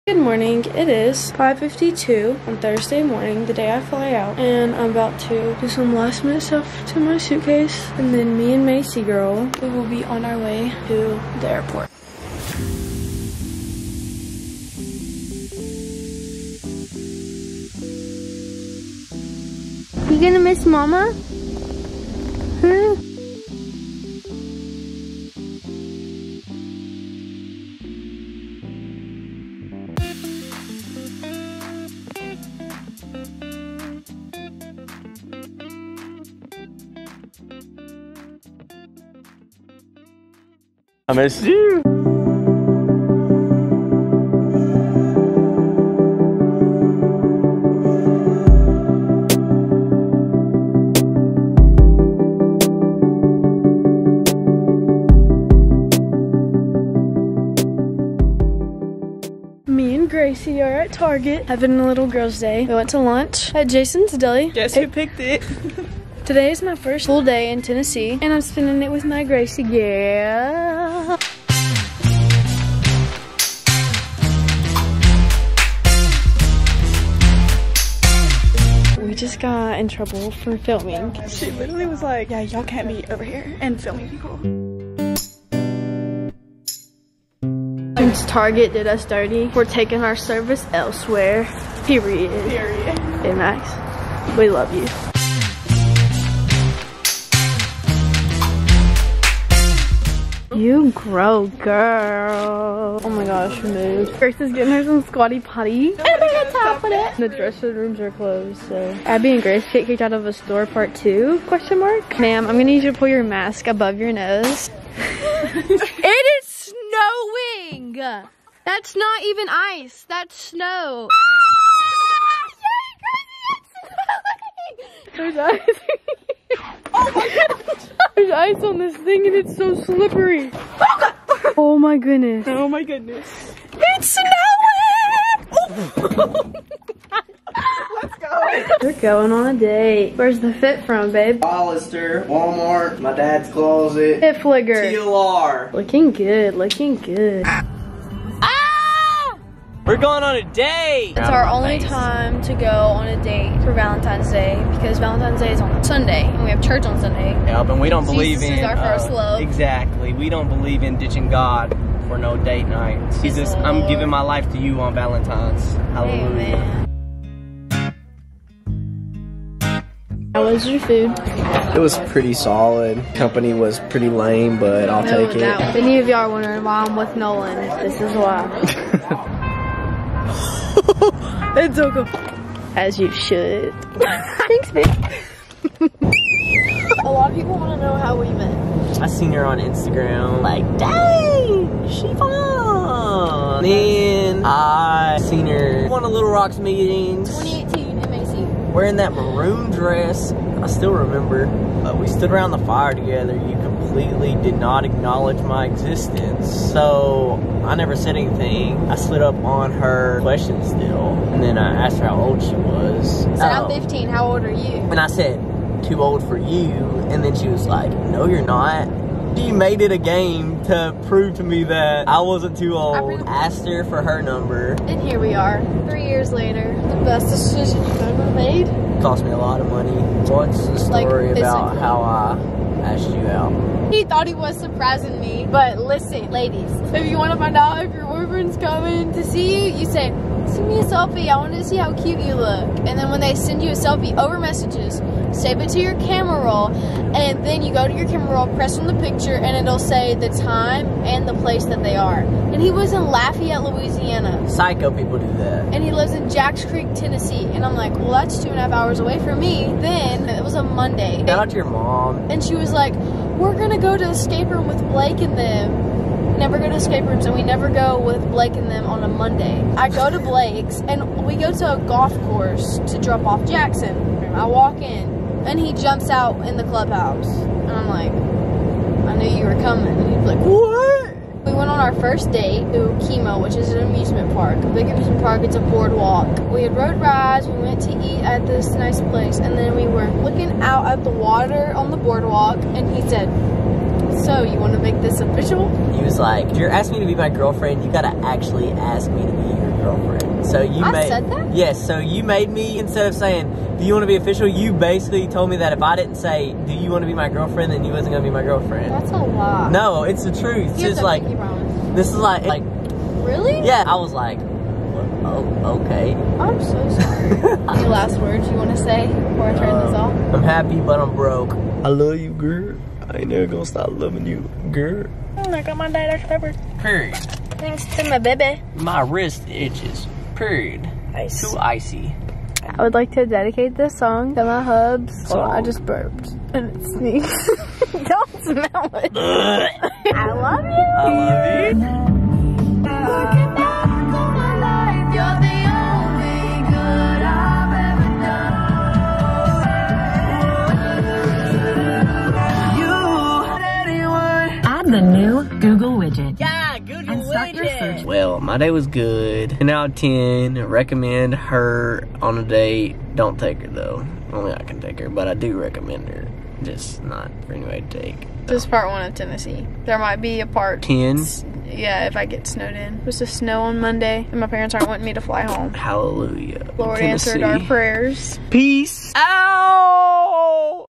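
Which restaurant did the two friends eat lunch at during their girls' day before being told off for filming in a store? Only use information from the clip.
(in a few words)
Jason's Deli.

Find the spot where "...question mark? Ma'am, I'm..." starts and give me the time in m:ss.
1:51.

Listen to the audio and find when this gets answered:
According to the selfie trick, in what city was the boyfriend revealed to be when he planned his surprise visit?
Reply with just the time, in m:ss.
4:13.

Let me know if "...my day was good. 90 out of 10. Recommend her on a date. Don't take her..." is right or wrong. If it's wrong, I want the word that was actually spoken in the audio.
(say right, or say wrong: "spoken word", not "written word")
wrong: "10", not "90".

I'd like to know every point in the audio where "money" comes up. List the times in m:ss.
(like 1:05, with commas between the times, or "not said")
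3:49.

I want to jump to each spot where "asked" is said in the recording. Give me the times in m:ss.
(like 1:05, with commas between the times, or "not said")
3:31, 3:43, 3:52.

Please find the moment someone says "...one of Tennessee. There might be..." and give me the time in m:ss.
6:08.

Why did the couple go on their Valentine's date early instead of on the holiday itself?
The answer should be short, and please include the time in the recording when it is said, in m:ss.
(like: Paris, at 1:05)
Church on Sunday, at 2:36.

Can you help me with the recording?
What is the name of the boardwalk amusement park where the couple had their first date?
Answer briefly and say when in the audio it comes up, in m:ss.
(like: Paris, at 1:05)
Kemah, at 4:43.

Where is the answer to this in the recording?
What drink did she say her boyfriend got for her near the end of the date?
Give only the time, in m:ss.
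5:25.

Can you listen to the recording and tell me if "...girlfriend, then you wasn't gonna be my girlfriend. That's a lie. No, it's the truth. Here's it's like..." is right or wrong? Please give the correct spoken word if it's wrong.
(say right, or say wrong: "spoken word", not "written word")
right.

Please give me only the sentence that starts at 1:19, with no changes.
We just got in trouble for filming.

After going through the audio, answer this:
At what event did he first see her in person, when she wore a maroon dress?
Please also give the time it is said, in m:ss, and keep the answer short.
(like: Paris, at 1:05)
2018 MAC, at 3:17.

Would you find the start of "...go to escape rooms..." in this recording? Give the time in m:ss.
4:26.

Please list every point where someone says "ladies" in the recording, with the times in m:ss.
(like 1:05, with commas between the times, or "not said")
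3:56.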